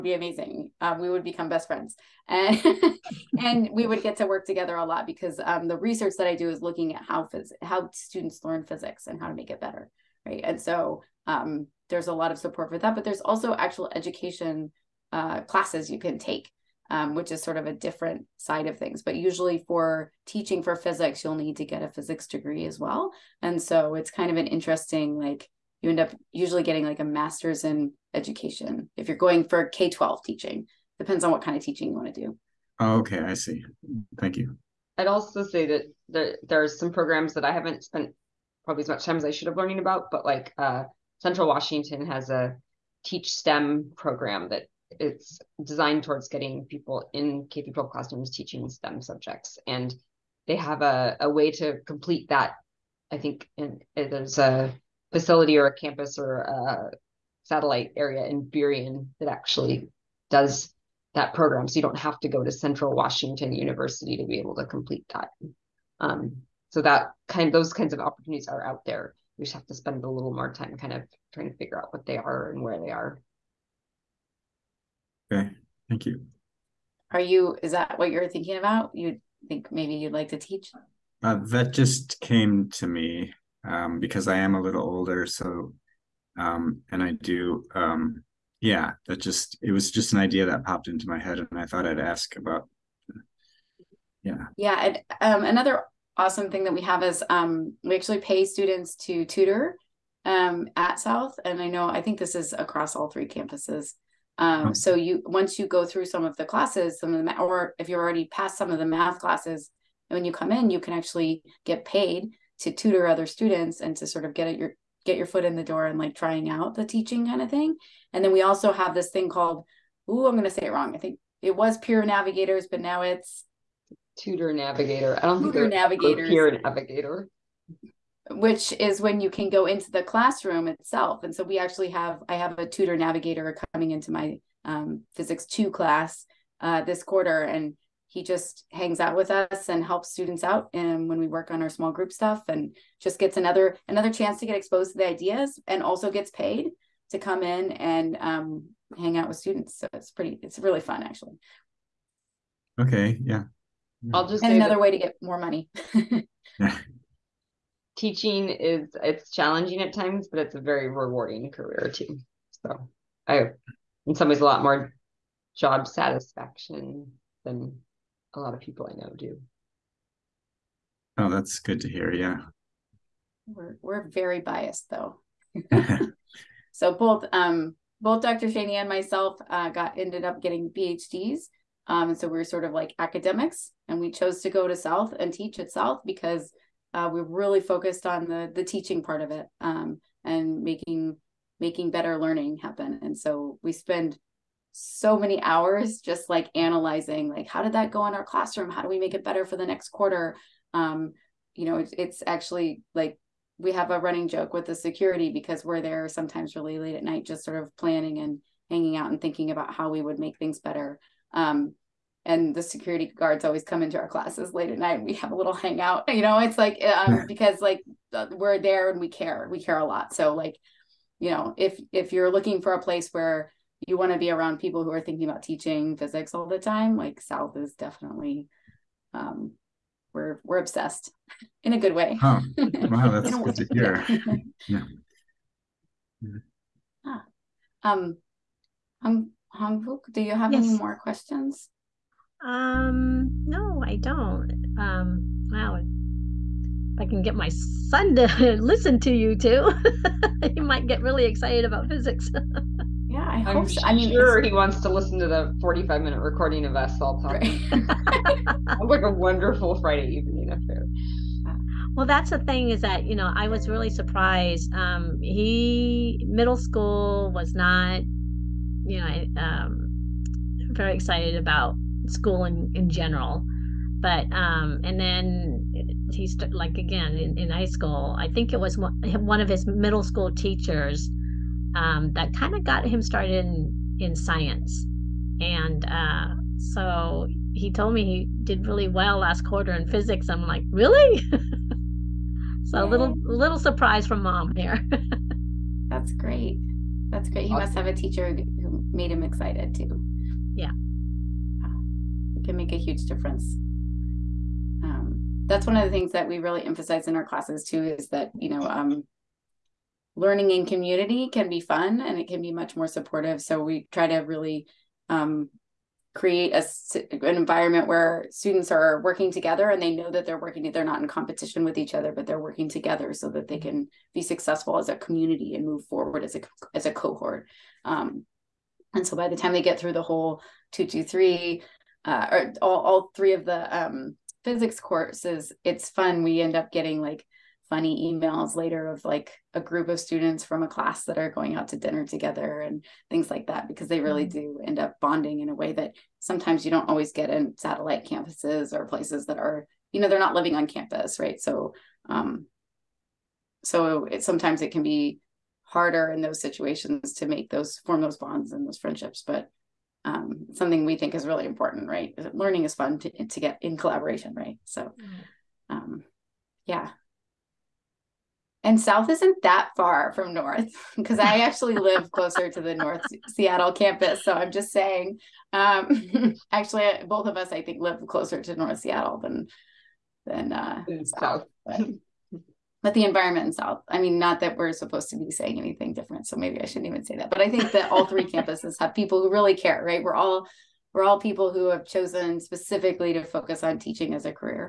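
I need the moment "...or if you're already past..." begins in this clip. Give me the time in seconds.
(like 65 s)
107 s.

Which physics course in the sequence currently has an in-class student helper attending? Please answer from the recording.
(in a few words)
physics two.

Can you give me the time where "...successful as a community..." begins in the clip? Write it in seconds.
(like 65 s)
324 s.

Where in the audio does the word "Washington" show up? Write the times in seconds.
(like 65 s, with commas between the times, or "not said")
41 s, 62 s.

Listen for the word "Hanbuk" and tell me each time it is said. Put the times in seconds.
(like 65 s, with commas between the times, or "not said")
239 s.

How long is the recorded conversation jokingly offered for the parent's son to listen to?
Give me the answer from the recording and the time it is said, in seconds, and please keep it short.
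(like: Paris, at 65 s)
45 minutes, at 255 s.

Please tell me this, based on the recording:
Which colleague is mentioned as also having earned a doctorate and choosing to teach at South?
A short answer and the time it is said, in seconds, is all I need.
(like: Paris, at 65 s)
Dr. Schoene, at 178 s.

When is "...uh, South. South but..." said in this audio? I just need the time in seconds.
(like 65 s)
380 s.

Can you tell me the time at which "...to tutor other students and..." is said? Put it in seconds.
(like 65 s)
112 s.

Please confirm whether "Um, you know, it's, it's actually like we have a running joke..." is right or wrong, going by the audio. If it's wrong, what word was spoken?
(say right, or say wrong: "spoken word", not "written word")
right.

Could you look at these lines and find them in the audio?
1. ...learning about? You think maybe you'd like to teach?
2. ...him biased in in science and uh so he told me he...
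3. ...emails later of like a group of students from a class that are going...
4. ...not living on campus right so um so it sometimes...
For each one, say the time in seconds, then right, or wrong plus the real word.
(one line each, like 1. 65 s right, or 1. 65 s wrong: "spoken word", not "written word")
1. 78 s wrong: "thinking", not "learning"
2. 282 s wrong: "started", not "biased"
3. 338 s right
4. 350 s right.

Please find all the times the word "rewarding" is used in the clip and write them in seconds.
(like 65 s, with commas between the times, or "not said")
160 s.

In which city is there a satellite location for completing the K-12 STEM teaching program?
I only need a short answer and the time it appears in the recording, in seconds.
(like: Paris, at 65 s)
Burien, at 58 s.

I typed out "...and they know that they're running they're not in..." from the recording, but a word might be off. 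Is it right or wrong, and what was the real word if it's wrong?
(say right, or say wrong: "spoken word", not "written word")
wrong: "working", not "running".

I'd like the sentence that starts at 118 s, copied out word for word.
And then we also have this thing called, ooh, I'm gonna say it wrong.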